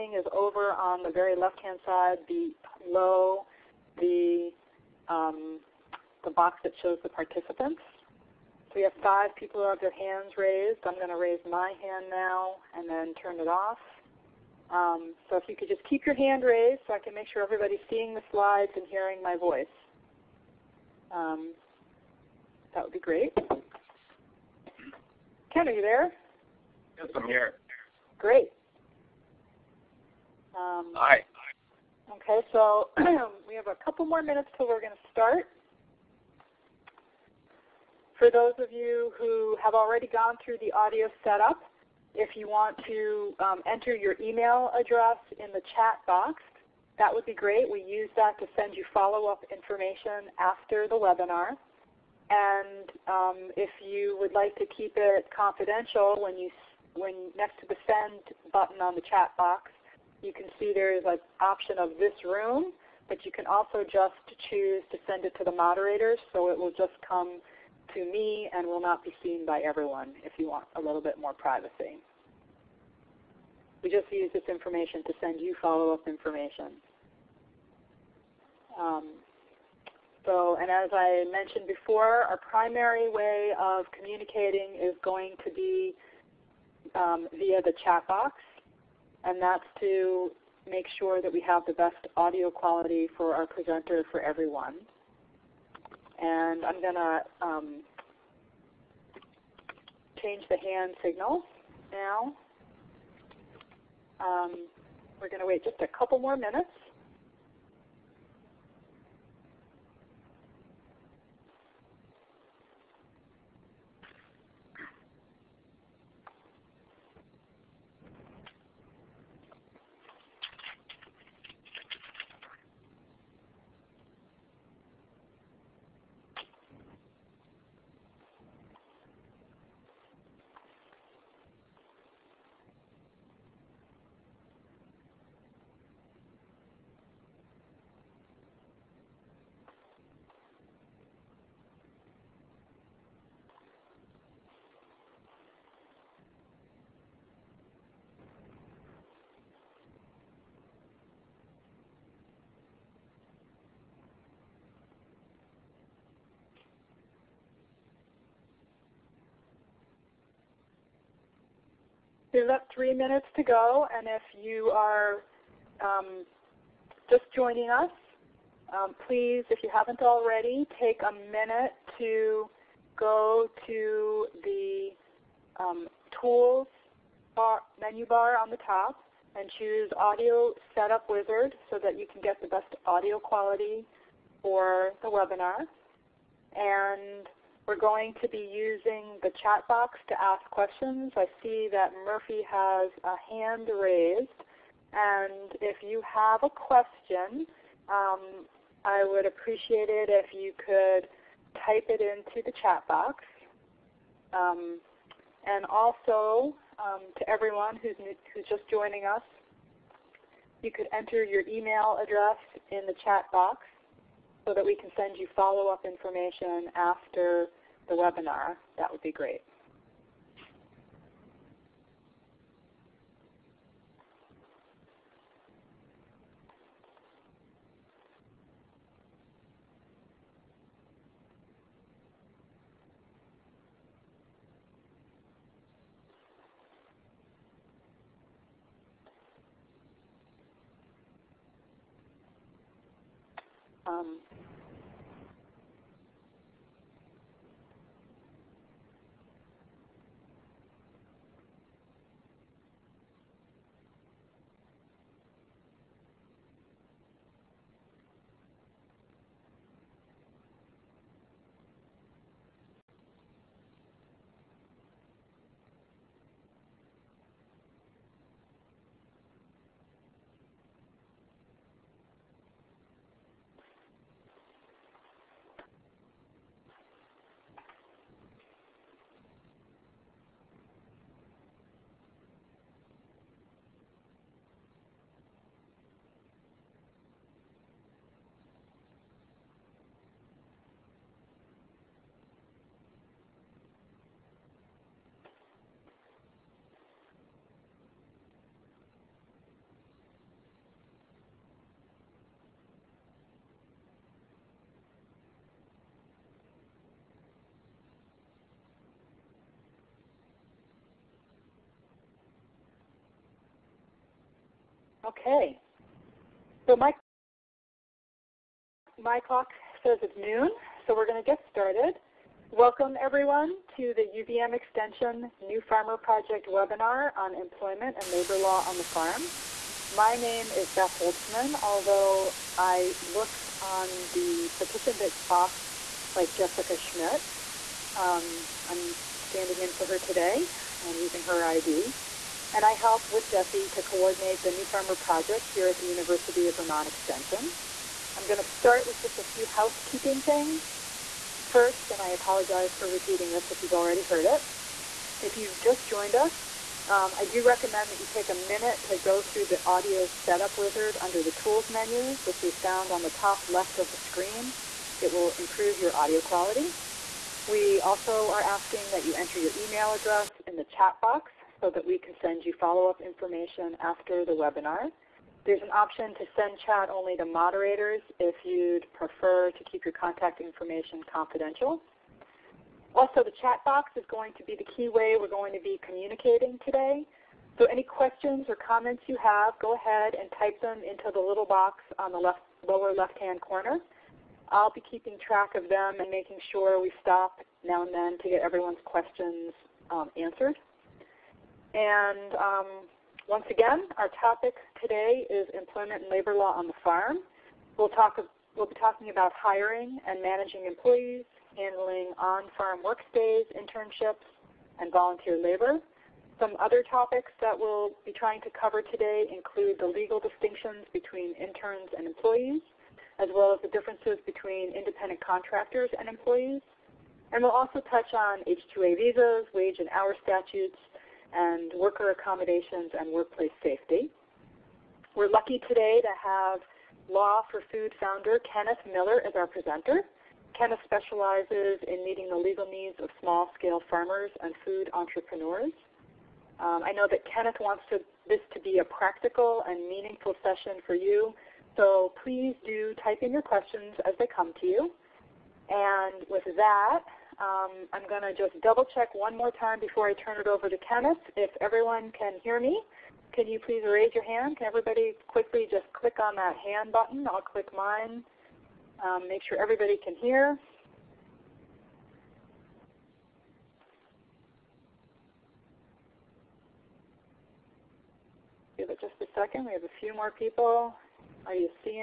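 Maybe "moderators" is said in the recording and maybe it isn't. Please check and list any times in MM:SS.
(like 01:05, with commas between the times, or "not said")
01:05, 06:17.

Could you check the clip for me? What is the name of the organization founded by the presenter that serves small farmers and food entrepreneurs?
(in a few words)
Law for Food.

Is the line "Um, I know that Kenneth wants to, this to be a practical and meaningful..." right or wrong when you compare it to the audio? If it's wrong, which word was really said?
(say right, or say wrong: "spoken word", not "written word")
right.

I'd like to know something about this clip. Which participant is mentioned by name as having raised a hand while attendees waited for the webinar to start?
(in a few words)
Murphy.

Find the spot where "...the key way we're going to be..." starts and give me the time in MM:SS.
06:24.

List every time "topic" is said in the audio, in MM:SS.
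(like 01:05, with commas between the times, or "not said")
06:44, 06:56.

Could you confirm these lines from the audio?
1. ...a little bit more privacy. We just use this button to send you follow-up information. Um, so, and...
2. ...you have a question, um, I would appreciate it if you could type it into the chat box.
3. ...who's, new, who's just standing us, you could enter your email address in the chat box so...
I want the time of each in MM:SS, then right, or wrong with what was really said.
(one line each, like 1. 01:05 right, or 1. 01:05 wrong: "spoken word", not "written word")
1. 01:10 wrong: "information", not "button"
2. 03:15 right
3. 03:27 wrong: "joining", not "standing".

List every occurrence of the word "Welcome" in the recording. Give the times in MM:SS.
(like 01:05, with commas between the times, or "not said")
05:22.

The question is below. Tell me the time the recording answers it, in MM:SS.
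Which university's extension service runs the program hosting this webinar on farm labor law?
05:45.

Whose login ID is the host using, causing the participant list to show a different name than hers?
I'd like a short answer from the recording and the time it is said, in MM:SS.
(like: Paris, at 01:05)
Jessica Schmidt, at 05:36.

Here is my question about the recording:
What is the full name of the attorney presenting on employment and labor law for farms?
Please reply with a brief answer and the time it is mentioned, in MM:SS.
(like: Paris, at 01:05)
Kenneth Miller, at 07:18.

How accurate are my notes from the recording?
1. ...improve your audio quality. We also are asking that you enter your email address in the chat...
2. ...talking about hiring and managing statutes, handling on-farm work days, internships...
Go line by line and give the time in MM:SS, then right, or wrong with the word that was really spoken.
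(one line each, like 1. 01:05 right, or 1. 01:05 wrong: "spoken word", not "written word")
1. 06:05 right
2. 06:48 wrong: "employees", not "statutes".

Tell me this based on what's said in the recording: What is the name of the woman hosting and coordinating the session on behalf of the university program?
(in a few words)
Beth Holtzman.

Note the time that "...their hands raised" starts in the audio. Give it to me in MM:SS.
00:09.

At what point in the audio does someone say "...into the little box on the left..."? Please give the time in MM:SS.
06:30.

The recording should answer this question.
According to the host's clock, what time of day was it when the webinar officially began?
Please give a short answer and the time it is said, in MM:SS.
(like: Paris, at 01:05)
noon, at 05:20.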